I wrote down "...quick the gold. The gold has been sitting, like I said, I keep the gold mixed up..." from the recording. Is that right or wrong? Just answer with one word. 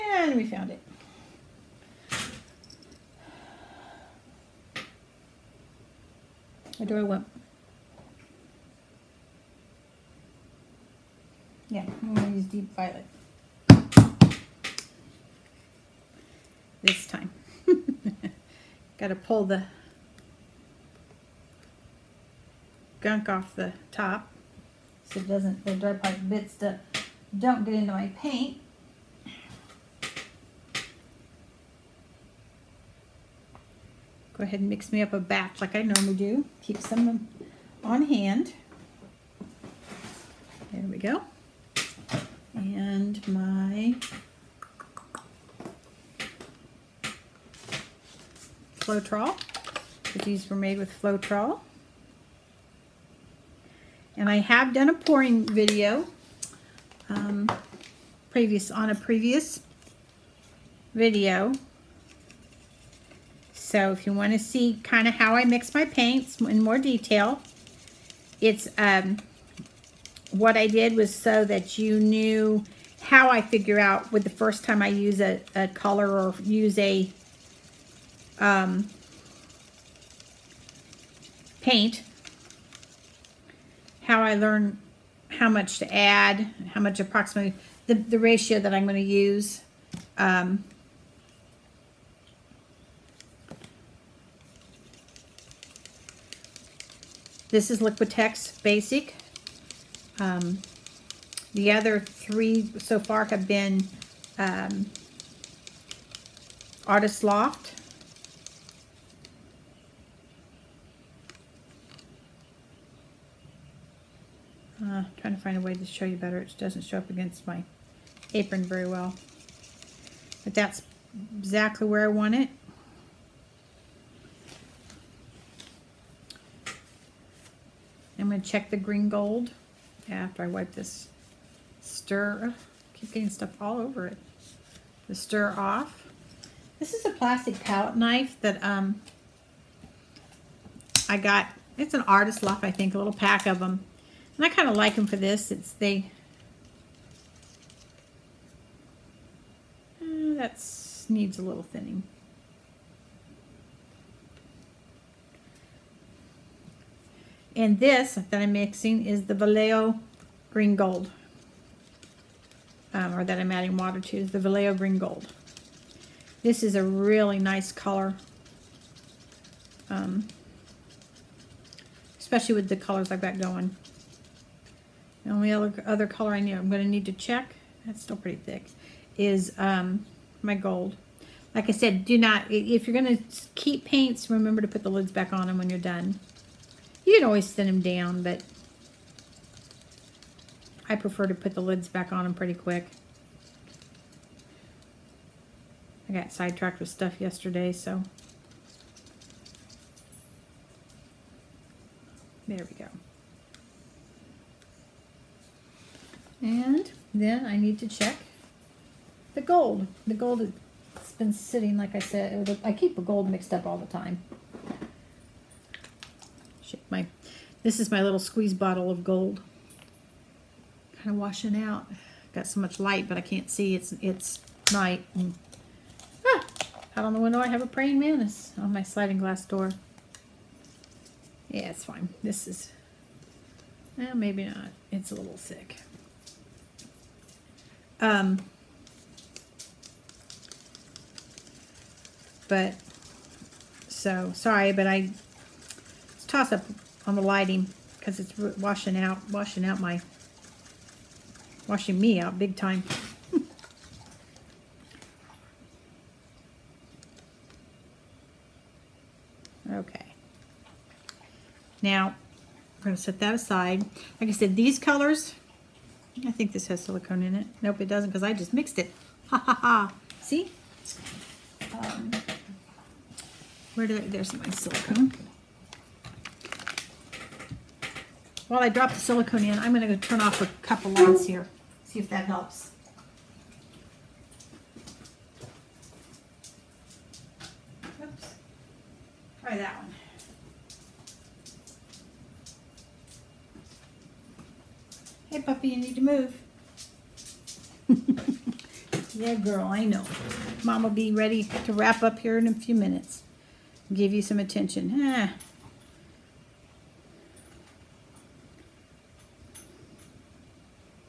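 wrong.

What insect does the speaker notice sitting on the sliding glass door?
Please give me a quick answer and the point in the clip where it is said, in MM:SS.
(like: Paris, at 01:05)
praying mantis, at 03:47.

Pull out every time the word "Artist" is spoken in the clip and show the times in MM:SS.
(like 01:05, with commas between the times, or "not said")
01:46, 02:22.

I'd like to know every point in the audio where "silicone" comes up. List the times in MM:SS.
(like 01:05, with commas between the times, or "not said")
04:26, 04:34, 04:38.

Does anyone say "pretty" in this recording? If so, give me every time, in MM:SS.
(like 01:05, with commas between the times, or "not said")
02:58, 03:12.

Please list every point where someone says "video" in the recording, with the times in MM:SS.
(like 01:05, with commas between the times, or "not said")
00:55, 01:00.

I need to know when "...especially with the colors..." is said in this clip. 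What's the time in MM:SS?
02:52.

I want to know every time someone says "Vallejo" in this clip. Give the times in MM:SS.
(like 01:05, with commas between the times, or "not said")
02:39, 02:44.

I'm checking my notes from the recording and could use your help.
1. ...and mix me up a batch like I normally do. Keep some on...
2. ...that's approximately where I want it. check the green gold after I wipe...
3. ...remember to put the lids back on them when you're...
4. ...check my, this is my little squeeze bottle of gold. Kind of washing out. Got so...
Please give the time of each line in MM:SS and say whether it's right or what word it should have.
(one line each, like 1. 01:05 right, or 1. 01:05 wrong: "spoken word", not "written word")
1. 00:34 right
2. 02:00 wrong: "exactly", not "approximately"
3. 03:04 right
4. 03:36 right.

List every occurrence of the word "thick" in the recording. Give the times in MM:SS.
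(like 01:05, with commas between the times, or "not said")
02:58, 03:55.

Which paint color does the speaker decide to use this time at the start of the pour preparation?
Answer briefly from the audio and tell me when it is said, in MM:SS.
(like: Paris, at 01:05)
deep violet, at 00:12.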